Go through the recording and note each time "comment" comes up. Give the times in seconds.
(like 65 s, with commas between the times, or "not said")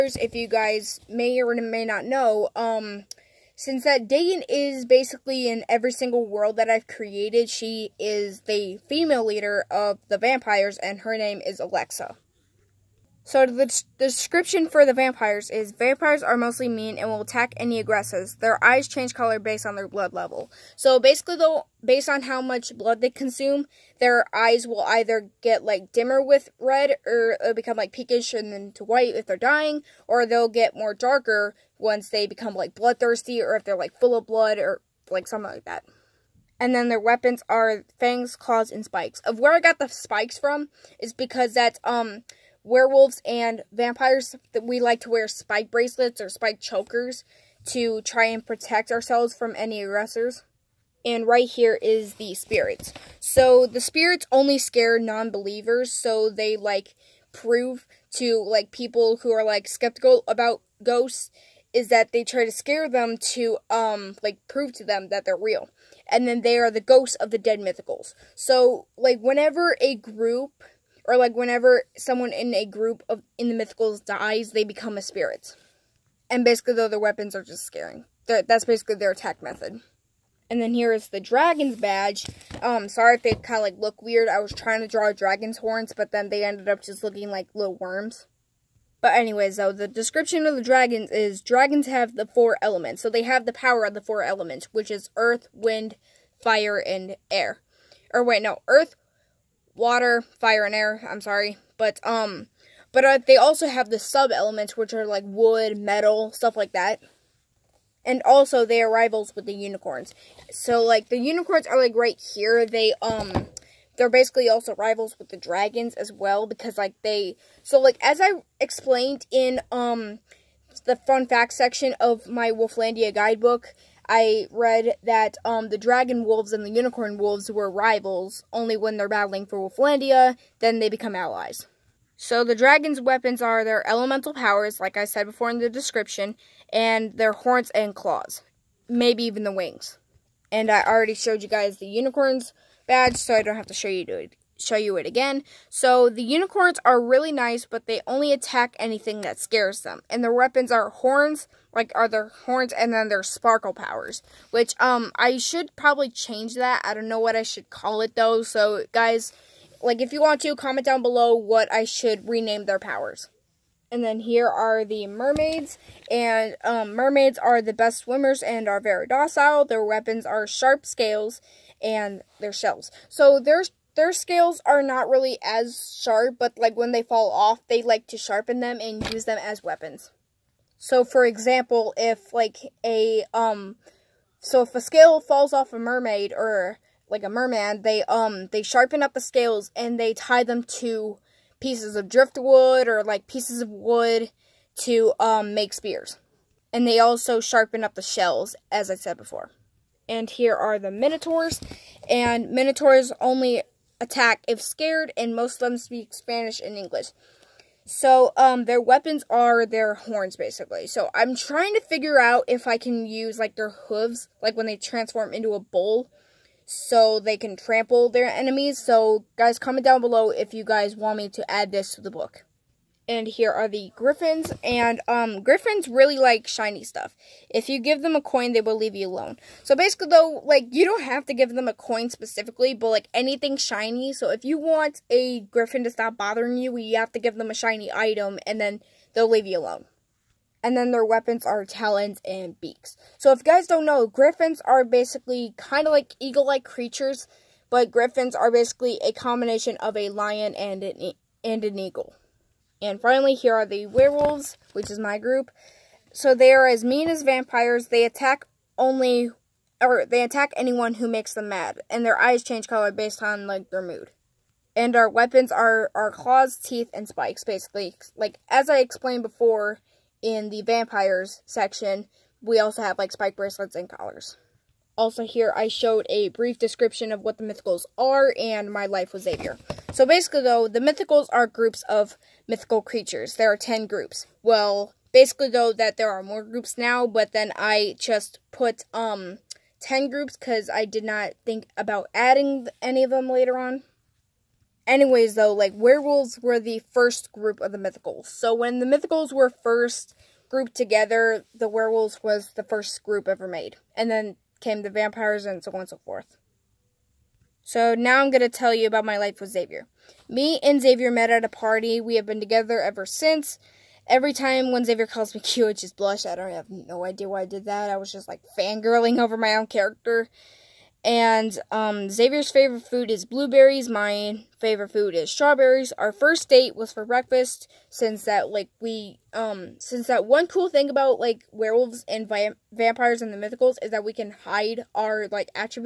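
160 s, 219 s.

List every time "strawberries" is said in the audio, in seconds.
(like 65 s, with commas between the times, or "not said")
325 s.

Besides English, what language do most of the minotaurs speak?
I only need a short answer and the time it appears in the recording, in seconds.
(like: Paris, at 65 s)
Spanish, at 206 s.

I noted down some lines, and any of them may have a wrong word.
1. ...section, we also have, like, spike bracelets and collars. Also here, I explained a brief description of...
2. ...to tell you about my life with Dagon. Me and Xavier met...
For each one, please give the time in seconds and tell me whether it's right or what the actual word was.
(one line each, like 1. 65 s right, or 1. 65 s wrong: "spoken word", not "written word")
1. 271 s wrong: "showed", not "explained"
2. 308 s wrong: "Xavier", not "Dagon".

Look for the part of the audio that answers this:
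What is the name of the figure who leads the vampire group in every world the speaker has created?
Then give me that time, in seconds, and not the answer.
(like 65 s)
11 s.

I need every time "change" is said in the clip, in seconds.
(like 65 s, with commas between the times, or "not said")
18 s, 156 s, 262 s.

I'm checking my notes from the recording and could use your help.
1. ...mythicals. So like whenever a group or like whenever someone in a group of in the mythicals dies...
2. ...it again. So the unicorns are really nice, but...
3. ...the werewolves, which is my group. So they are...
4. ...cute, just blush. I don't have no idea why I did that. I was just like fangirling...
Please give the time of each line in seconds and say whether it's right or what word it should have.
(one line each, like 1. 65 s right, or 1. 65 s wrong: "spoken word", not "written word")
1. 67 s right
2. 144 s right
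3. 253 s right
4. 315 s right.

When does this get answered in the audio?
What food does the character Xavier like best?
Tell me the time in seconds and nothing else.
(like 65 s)
323 s.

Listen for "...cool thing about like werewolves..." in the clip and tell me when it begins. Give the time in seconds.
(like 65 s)
330 s.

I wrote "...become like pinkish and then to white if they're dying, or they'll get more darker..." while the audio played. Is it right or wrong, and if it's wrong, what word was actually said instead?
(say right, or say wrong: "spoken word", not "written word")
right.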